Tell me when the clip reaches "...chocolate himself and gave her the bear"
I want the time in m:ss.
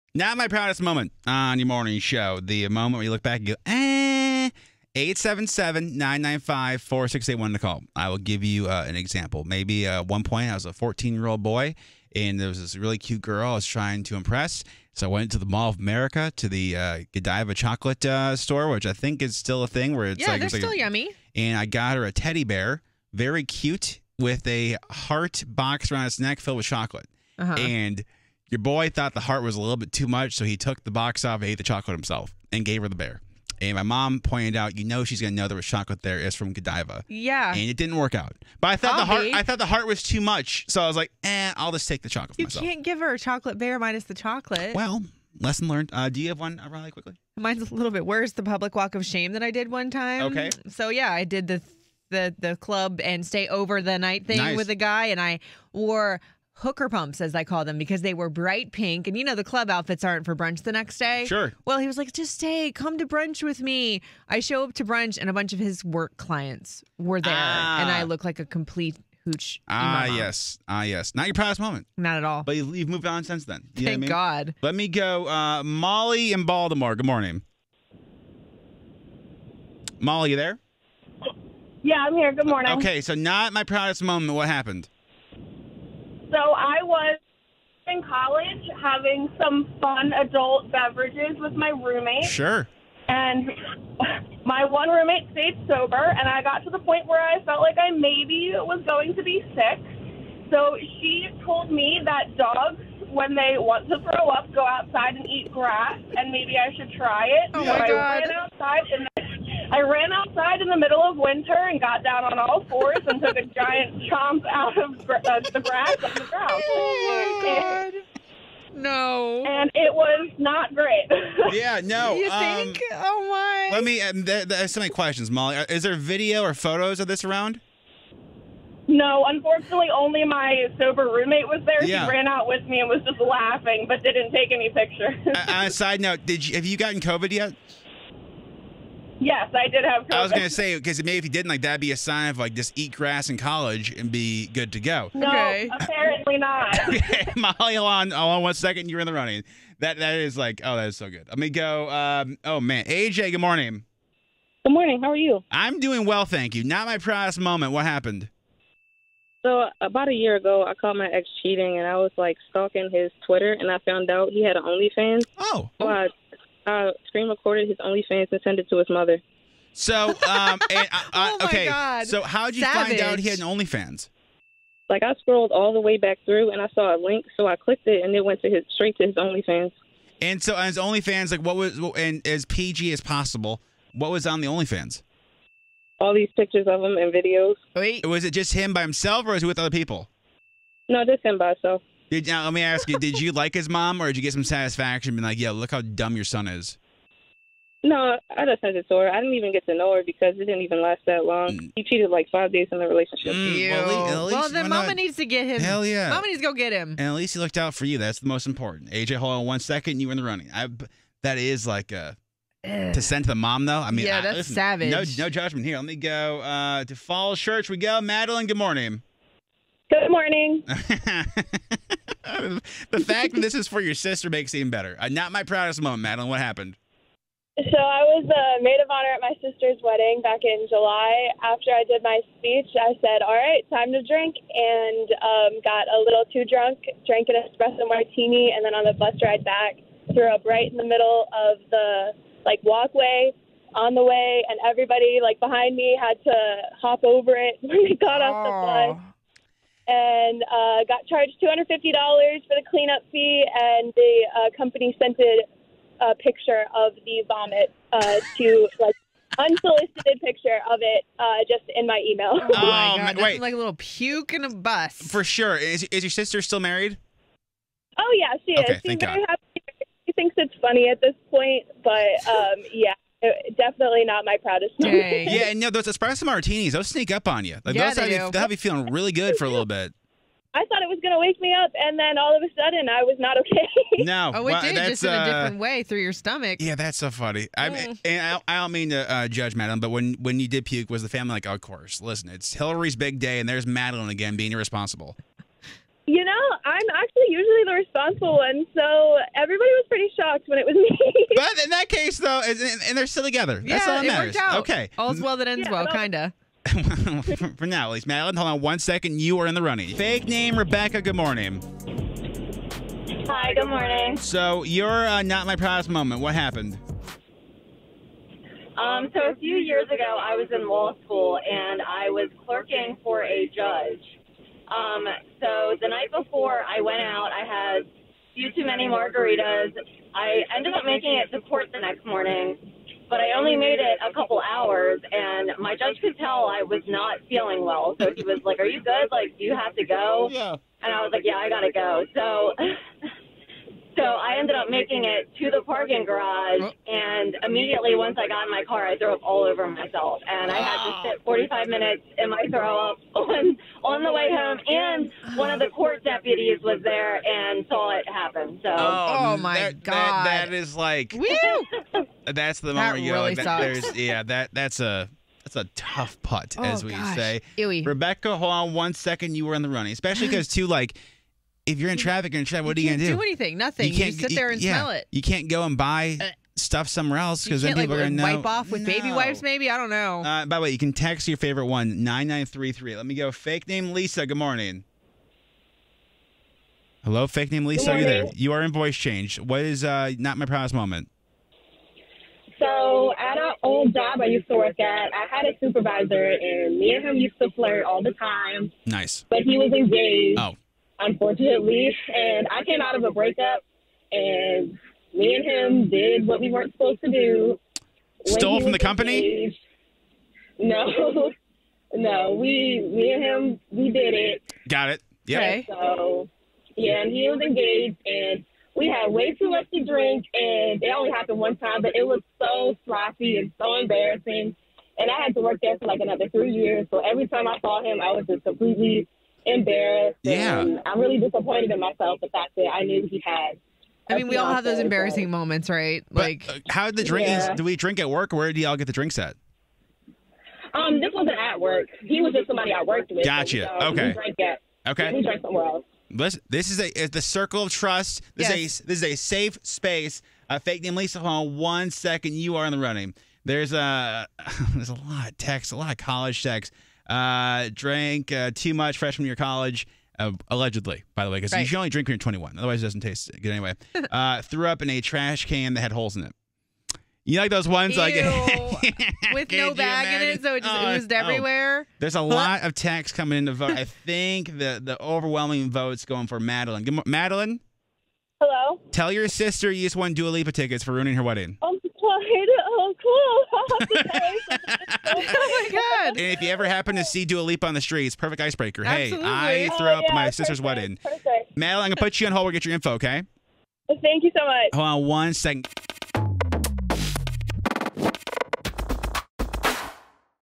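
0:31.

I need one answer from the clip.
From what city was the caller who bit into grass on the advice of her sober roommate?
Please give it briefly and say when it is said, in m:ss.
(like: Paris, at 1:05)
Baltimore, at 1:16.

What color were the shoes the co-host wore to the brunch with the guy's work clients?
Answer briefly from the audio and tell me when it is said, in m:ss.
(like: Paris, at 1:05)
Bright pink, at 0:58.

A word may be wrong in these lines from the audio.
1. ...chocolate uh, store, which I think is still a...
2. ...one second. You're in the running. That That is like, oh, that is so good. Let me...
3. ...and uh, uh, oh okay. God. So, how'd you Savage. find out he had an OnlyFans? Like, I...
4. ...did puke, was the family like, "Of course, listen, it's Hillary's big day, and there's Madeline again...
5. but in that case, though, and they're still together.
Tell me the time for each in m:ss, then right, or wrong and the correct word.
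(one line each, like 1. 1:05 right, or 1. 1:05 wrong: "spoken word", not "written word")
1. 0:17 right
2. 2:28 right
3. 2:50 right
4. 4:50 right
5. 5:01 right.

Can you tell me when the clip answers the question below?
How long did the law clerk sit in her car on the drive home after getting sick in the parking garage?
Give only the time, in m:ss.
5:51.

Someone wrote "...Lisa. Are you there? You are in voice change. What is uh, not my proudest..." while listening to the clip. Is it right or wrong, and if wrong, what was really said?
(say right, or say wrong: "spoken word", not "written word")
right.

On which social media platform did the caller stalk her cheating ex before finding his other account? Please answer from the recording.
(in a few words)
Twitter.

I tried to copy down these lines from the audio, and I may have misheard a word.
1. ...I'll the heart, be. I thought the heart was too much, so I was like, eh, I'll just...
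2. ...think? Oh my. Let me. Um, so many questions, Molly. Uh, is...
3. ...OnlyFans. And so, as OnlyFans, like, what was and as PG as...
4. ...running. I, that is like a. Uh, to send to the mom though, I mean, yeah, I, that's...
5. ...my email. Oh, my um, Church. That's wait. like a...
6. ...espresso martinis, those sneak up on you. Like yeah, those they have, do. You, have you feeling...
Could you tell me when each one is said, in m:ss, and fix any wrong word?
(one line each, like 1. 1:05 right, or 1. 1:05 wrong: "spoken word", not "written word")
1. 0:38 right
2. 2:02 right
3. 2:59 right
4. 3:30 right
5. 4:21 wrong: "God", not "Church"
6. 4:35 right.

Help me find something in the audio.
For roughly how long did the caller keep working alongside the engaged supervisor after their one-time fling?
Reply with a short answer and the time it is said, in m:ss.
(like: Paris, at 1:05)
3 years, at 7:06.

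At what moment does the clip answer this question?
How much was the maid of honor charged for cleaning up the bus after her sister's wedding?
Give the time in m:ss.
4:11.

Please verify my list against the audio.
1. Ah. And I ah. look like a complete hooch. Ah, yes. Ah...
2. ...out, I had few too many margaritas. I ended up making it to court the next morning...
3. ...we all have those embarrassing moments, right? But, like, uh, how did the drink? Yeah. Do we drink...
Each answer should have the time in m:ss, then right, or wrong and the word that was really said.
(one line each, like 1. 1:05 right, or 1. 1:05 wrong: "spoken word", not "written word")
1. 1:07 right
2. 5:27 right
3. 7:14 right.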